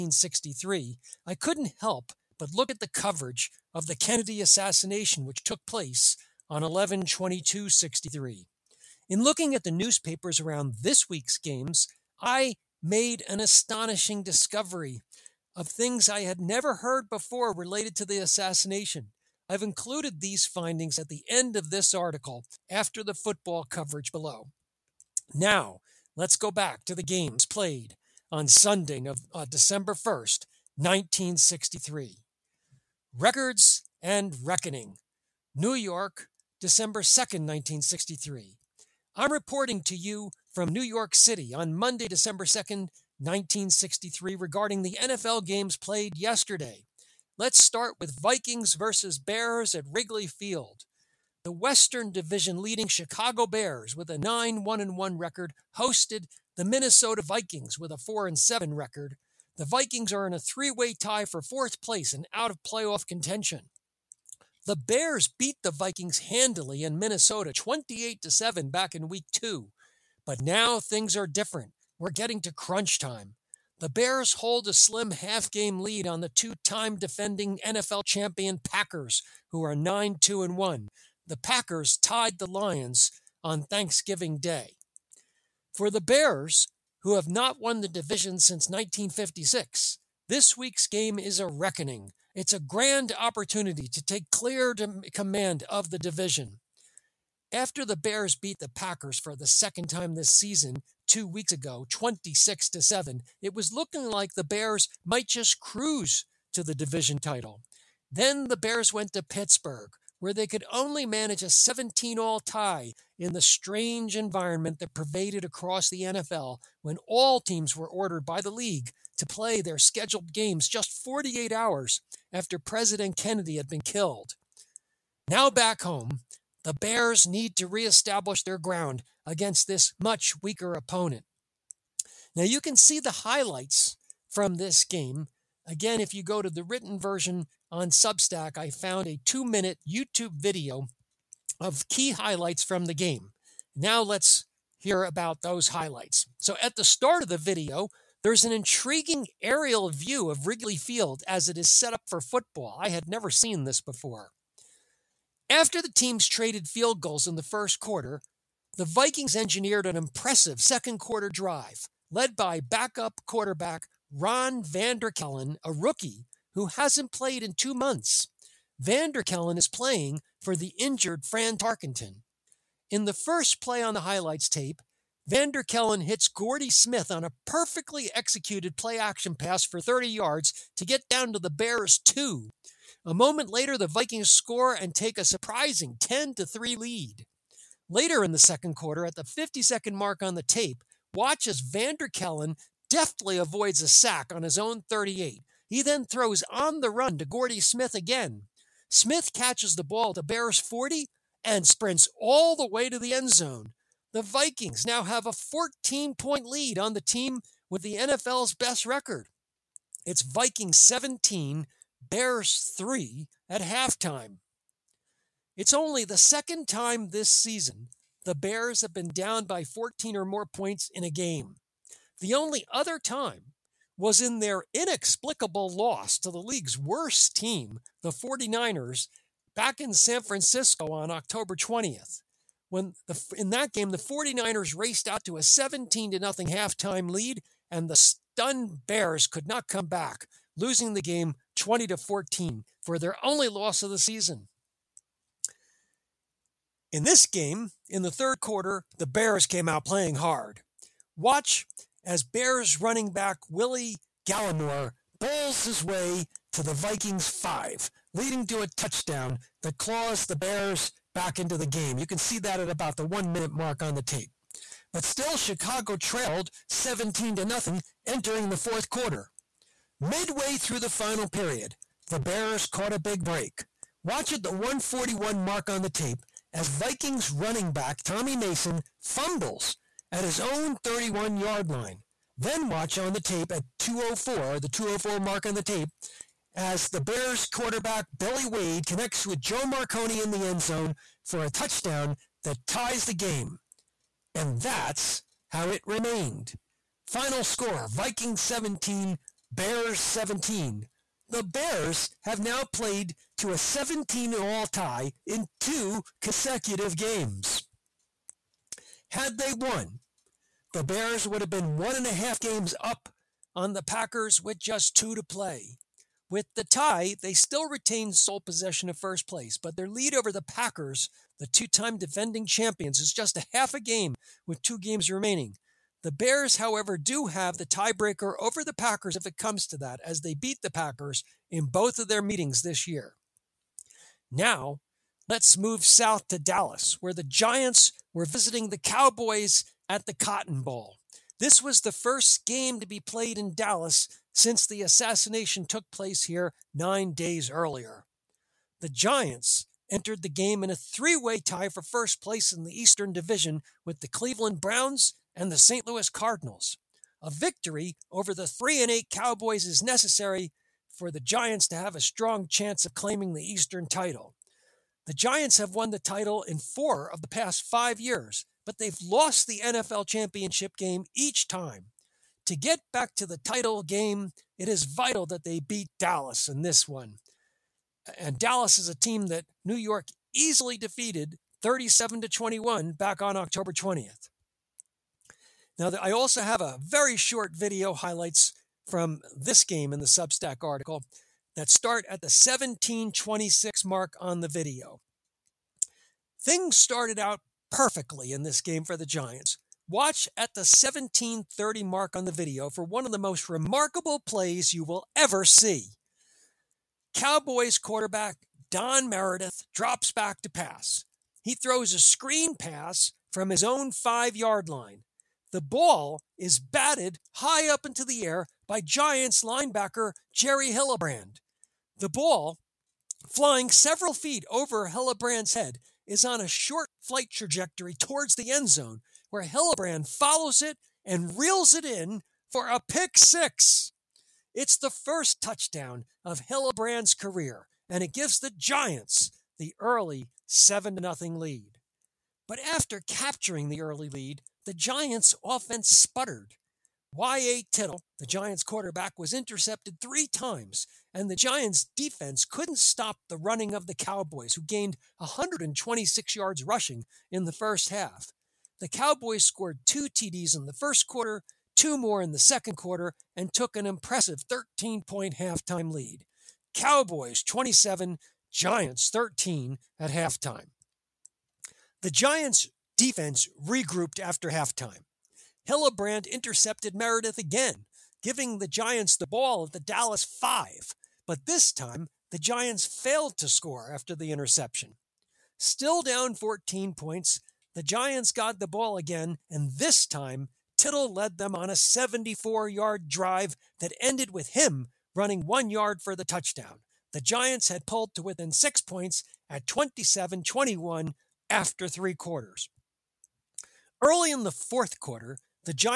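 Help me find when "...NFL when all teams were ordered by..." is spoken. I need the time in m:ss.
1:56.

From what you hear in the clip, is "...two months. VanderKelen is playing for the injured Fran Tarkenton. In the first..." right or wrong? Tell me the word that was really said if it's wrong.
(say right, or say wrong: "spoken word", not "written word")
right.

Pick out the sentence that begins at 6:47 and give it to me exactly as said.
Cowboys quarterback Don Meredith drops back to pass.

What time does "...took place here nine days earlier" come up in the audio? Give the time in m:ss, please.
5:45.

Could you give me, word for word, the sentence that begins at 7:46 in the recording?
Cowboys 27, Giants 13 at halftime.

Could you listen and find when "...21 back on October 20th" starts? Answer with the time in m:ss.
6:22.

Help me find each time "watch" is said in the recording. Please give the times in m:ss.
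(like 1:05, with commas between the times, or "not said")
3:11, 4:11, 4:34, 4:42, 6:39.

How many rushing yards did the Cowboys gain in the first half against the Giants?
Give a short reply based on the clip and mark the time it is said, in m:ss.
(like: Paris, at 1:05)
126, at 7:35.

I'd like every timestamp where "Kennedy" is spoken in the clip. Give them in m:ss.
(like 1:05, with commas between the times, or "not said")
0:03, 2:03.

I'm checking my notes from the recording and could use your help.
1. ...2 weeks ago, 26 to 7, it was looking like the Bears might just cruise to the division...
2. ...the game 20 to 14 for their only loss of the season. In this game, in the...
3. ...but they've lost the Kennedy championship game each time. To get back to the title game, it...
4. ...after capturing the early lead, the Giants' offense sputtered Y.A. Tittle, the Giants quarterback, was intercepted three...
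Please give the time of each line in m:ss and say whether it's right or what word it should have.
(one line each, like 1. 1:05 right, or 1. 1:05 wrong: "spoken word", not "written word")
1. 1:41 right
2. 4:00 right
3. 6:08 wrong: "NFL", not "Kennedy"
4. 7:22 right.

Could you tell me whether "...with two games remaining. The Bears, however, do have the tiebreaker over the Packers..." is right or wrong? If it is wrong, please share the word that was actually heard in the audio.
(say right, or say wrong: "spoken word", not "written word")
right.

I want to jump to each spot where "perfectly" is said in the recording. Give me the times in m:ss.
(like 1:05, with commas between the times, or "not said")
2:57, 6:37.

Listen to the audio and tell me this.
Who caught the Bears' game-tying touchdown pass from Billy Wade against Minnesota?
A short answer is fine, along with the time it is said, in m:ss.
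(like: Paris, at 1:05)
Joe Marconi, at 4:49.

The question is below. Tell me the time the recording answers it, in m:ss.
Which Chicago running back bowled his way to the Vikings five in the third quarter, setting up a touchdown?
4:13.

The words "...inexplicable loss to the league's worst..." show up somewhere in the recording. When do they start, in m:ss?
3:44.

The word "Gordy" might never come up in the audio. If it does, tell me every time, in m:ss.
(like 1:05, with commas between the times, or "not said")
2:56, 3:17.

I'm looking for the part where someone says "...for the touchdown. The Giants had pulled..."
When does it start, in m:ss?
8:16.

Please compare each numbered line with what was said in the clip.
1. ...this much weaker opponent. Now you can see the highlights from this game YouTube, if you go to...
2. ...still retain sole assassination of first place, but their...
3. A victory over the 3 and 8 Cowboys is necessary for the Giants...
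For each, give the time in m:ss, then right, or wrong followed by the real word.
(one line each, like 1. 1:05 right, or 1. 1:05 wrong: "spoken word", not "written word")
1. 2:09 wrong: "Again", not "YouTube"
2. 5:17 wrong: "possession", not "assassination"
3. 5:57 right.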